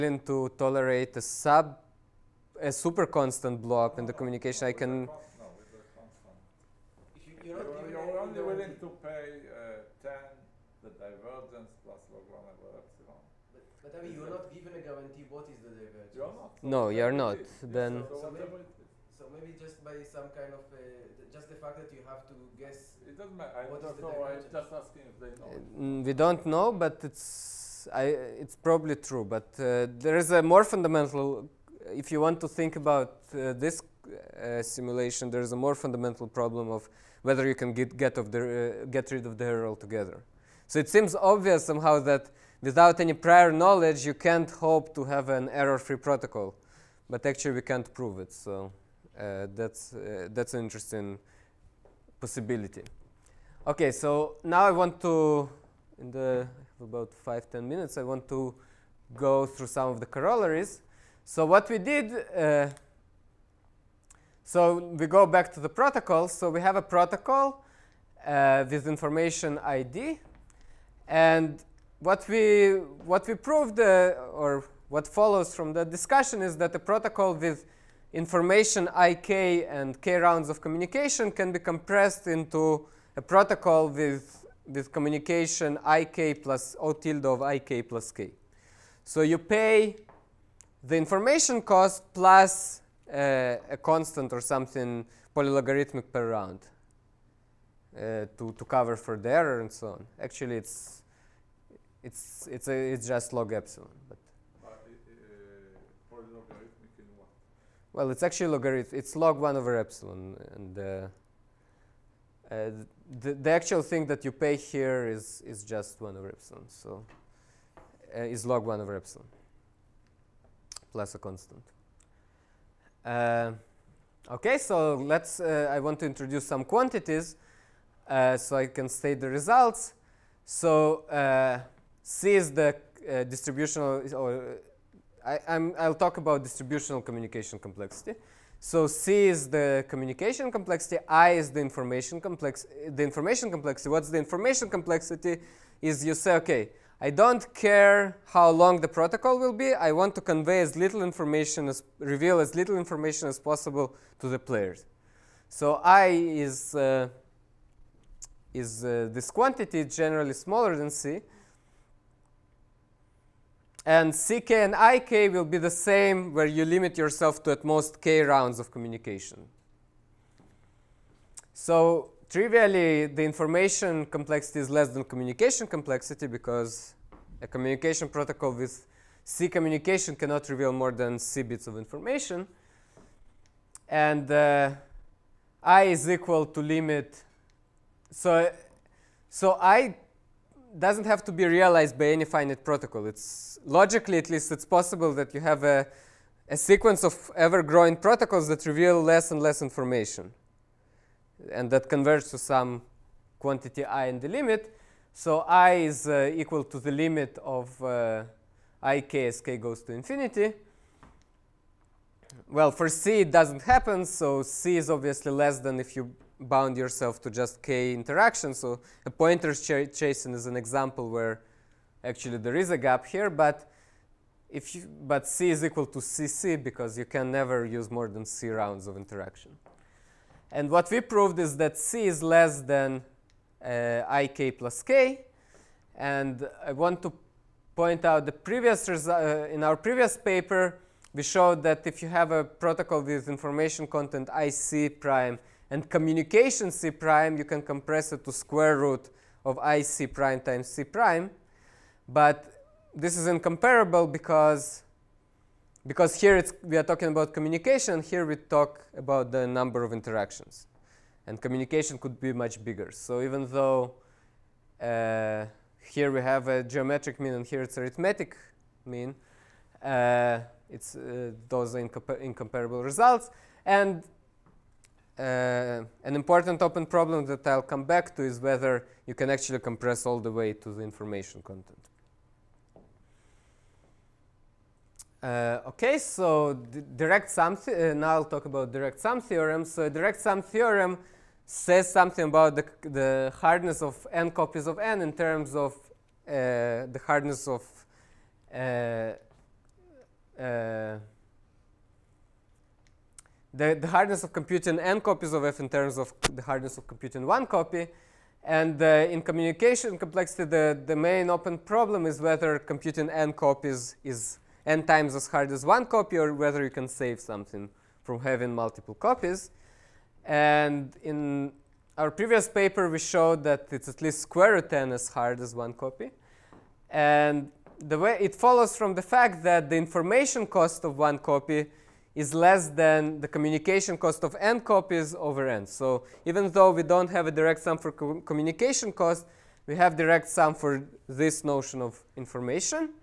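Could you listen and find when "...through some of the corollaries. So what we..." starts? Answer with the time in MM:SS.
00:59.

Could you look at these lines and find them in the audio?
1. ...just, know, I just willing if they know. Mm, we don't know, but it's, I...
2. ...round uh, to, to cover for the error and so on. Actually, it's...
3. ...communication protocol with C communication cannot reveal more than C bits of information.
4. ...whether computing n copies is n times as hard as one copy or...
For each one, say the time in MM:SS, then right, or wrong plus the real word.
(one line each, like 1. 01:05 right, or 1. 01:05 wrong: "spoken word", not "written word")
1. 00:23 wrong: "asking", not "willing"
2. 01:36 right
3. 02:57 right
4. 05:12 right.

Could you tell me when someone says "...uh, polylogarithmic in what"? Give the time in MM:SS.
01:44.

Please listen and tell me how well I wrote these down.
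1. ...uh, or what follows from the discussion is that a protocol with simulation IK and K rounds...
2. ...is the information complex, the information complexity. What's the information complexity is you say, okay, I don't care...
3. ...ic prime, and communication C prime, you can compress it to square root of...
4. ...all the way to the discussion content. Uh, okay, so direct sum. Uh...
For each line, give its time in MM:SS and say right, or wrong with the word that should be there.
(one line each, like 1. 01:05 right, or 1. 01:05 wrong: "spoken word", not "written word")
1. 01:13 wrong: "information", not "simulation"
2. 02:21 right
3. 04:04 right
4. 04:40 wrong: "information", not "discussion".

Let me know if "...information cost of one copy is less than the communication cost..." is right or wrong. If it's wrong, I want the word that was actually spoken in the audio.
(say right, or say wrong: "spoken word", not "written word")
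right.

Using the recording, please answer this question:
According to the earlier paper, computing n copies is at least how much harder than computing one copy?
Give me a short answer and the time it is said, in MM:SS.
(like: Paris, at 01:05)
square root n, at 05:24.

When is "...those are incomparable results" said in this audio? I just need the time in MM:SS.
04:31.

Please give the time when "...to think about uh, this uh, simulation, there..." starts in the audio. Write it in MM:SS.
00:32.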